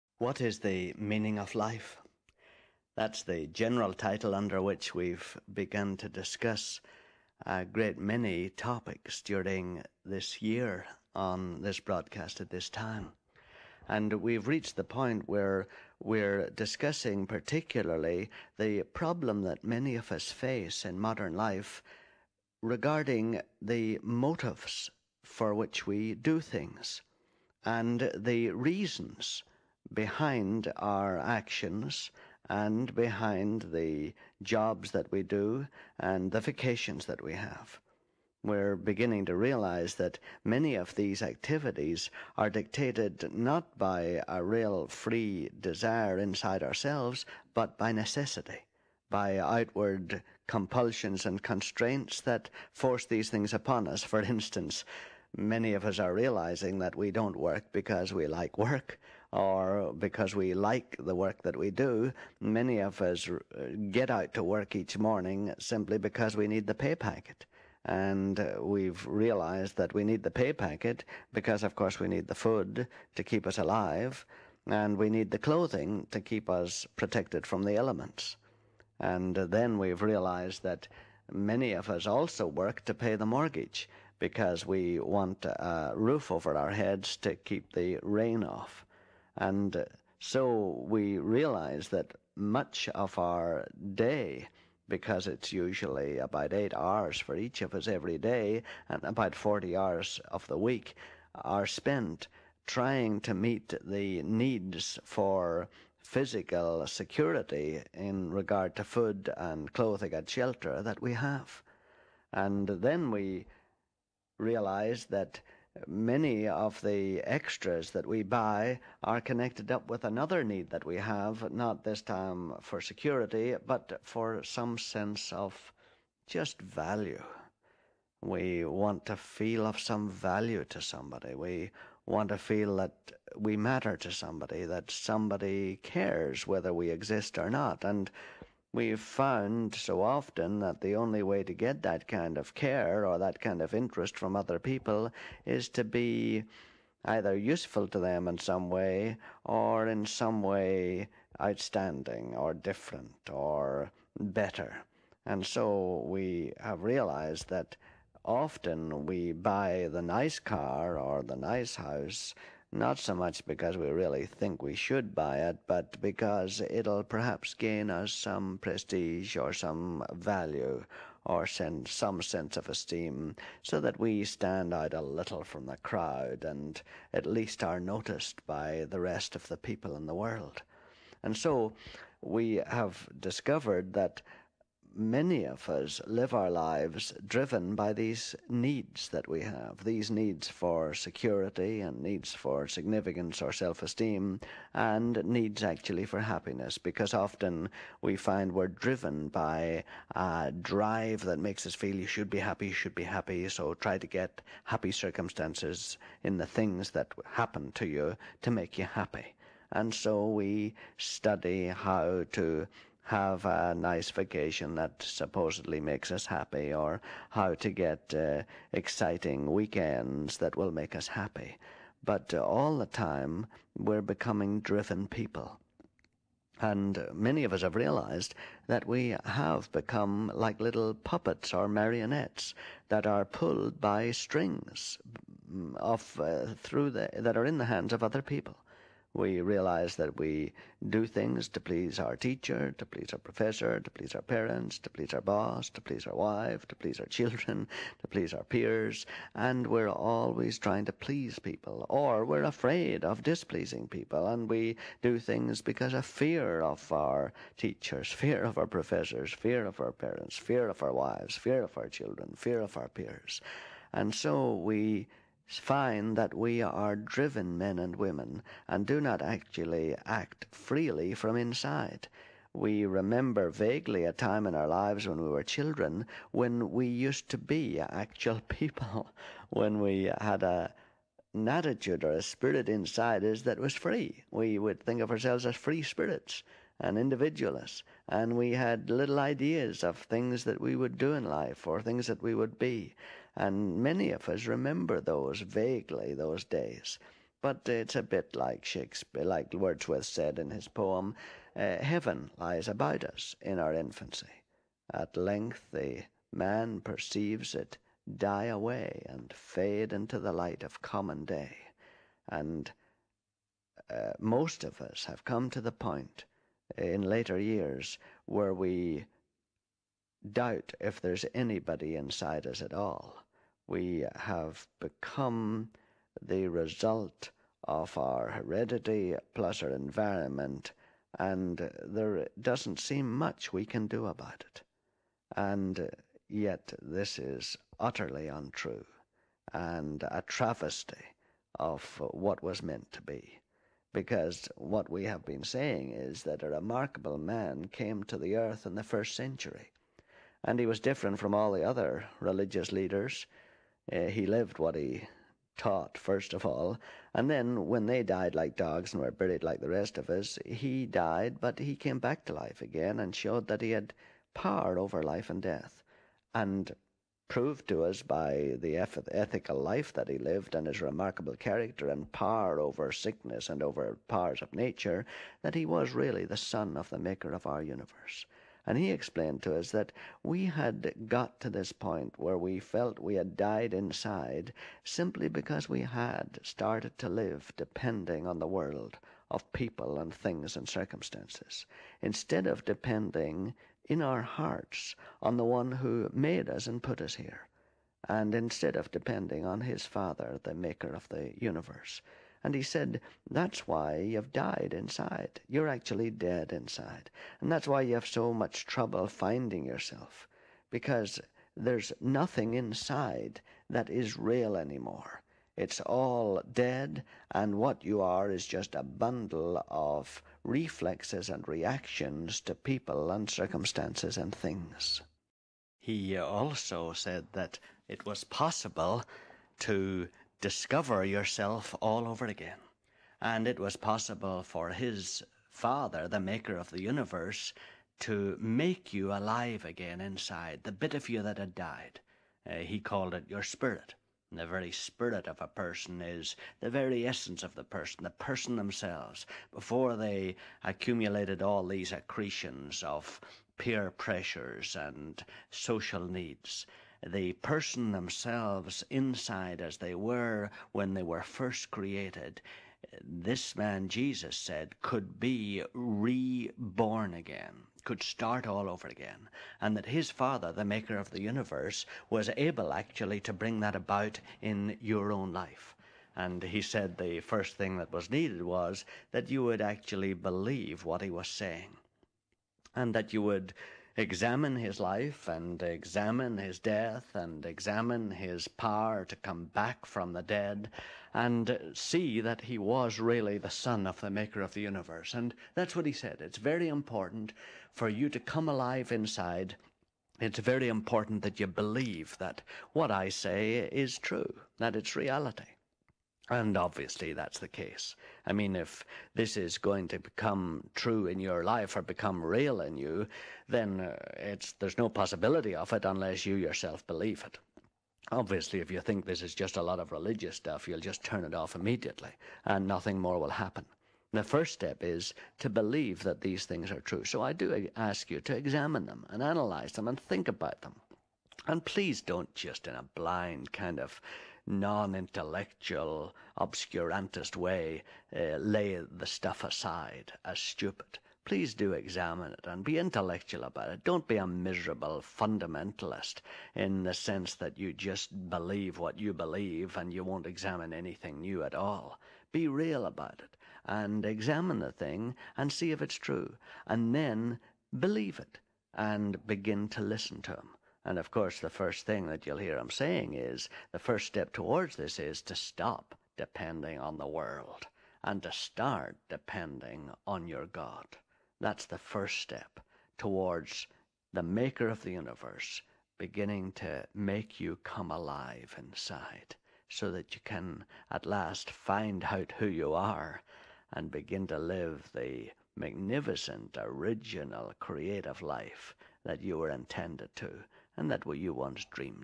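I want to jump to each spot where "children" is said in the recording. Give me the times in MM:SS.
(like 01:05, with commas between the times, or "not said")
04:07, 04:21, 04:35.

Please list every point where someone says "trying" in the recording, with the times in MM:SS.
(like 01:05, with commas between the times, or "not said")
01:42, 04:10.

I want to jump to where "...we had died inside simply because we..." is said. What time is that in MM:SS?
06:22.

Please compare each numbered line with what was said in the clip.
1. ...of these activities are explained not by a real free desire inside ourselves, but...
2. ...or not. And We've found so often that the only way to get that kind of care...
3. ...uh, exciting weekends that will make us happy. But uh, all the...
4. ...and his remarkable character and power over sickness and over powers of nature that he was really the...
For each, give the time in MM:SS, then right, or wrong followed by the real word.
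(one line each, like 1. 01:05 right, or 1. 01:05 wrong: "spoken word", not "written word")
1. 00:40 wrong: "dictated", not "explained"
2. 02:17 right
3. 03:38 right
4. 06:10 right.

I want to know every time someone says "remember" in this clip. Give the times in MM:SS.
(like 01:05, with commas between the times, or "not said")
04:32, 04:54.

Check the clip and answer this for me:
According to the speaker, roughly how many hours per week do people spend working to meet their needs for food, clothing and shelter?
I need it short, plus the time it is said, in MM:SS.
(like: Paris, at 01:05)
40, at 01:39.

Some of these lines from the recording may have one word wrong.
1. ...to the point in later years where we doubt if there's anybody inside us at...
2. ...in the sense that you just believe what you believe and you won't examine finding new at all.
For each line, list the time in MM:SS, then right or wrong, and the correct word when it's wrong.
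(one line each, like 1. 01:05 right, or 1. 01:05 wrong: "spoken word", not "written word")
1. 05:15 right
2. 09:06 wrong: "anything", not "finding".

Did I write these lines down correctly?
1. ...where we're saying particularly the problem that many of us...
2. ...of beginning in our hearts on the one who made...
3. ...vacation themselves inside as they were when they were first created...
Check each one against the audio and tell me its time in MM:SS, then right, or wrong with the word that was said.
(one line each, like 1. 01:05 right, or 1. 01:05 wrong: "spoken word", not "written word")
1. 00:15 wrong: "discussing", not "saying"
2. 06:32 wrong: "depending", not "beginning"
3. 07:37 wrong: "person", not "vacation".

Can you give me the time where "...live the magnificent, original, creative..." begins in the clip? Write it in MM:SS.
09:44.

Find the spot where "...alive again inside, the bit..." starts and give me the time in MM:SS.
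07:19.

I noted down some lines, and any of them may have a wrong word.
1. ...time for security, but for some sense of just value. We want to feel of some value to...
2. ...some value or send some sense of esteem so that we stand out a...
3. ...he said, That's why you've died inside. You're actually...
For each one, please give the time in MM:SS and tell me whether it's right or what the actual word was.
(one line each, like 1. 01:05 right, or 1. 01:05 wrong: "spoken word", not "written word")
1. 02:02 right
2. 02:49 right
3. 06:42 right.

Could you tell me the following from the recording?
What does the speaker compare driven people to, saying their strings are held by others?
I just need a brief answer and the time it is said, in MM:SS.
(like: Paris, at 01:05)
puppets or marionettes, at 03:50.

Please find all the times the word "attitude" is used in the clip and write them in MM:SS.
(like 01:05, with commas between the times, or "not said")
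04:41.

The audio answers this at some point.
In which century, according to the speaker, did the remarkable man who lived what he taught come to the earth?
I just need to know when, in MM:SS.
05:48.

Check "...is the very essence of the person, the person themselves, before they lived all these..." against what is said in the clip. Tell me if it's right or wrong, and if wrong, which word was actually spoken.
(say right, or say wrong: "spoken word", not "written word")
wrong: "accumulated", not "lived".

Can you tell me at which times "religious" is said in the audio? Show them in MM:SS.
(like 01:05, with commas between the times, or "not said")
05:52, 08:39.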